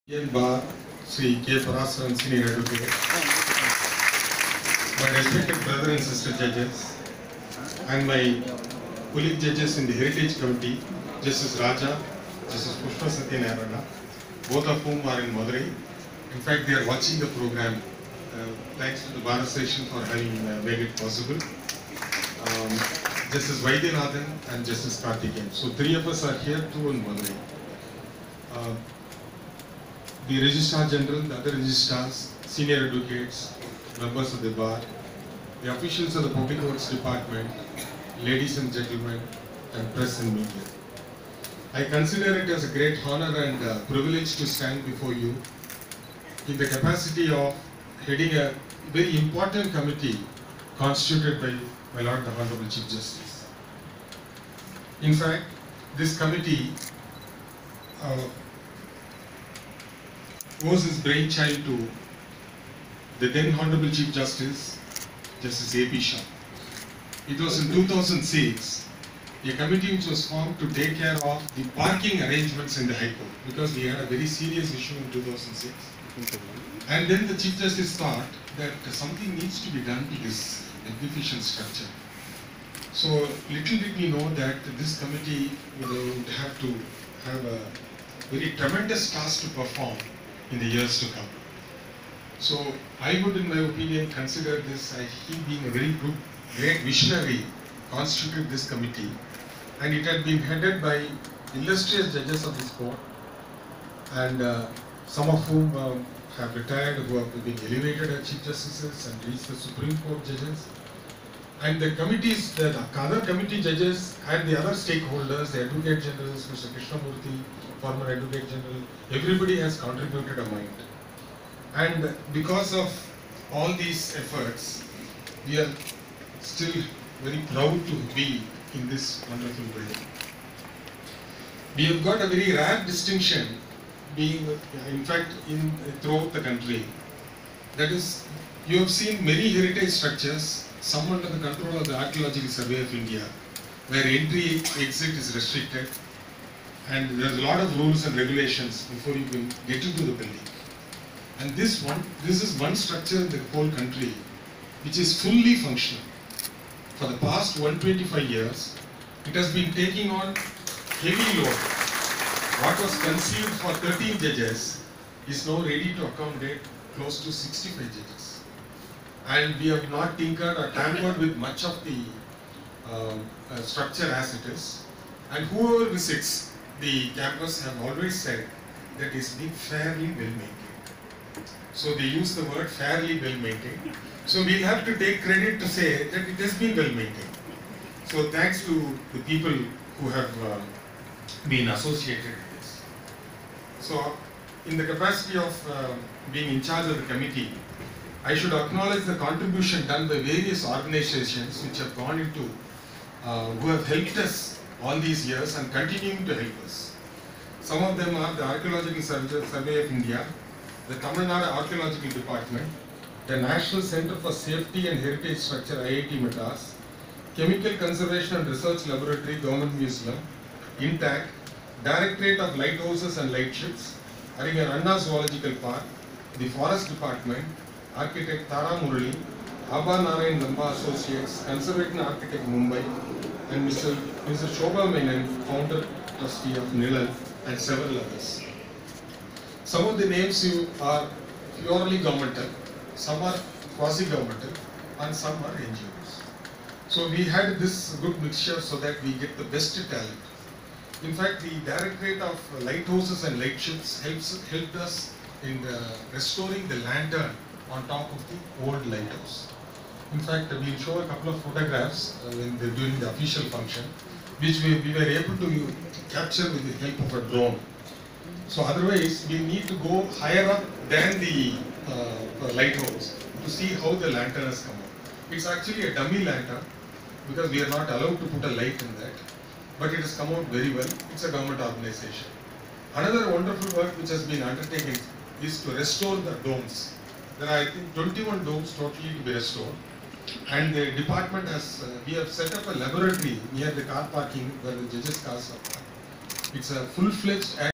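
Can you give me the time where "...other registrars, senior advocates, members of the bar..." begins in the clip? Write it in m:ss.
0:31.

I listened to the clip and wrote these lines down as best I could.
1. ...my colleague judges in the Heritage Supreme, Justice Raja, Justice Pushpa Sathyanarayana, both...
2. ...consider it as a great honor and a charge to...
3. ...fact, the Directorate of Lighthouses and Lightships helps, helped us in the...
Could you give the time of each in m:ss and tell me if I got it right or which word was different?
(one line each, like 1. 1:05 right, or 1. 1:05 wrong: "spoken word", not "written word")
1. 0:08 wrong: "Committee", not "Supreme"
2. 0:41 wrong: "privilege", not "charge"
3. 4:11 right.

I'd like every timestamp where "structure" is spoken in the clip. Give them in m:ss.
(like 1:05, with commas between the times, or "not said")
1:21, 2:19, 2:32, 2:53, 3:35.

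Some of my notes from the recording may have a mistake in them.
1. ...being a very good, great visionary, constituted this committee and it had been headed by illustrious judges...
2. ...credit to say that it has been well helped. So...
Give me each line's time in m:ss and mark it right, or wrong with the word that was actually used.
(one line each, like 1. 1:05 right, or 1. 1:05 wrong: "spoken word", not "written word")
1. 1:35 right
2. 3:05 wrong: "maintained", not "helped".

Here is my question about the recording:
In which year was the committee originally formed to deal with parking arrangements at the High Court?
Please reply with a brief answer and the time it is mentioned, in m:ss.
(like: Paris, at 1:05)
2006, at 1:07.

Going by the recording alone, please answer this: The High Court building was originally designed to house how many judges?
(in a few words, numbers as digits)
13.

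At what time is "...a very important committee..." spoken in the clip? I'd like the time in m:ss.
0:48.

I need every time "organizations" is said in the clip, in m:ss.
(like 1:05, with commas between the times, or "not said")
3:20, 4:41.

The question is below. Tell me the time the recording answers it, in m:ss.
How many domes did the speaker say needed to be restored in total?
4:47.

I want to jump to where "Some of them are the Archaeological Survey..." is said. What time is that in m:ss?
3:27.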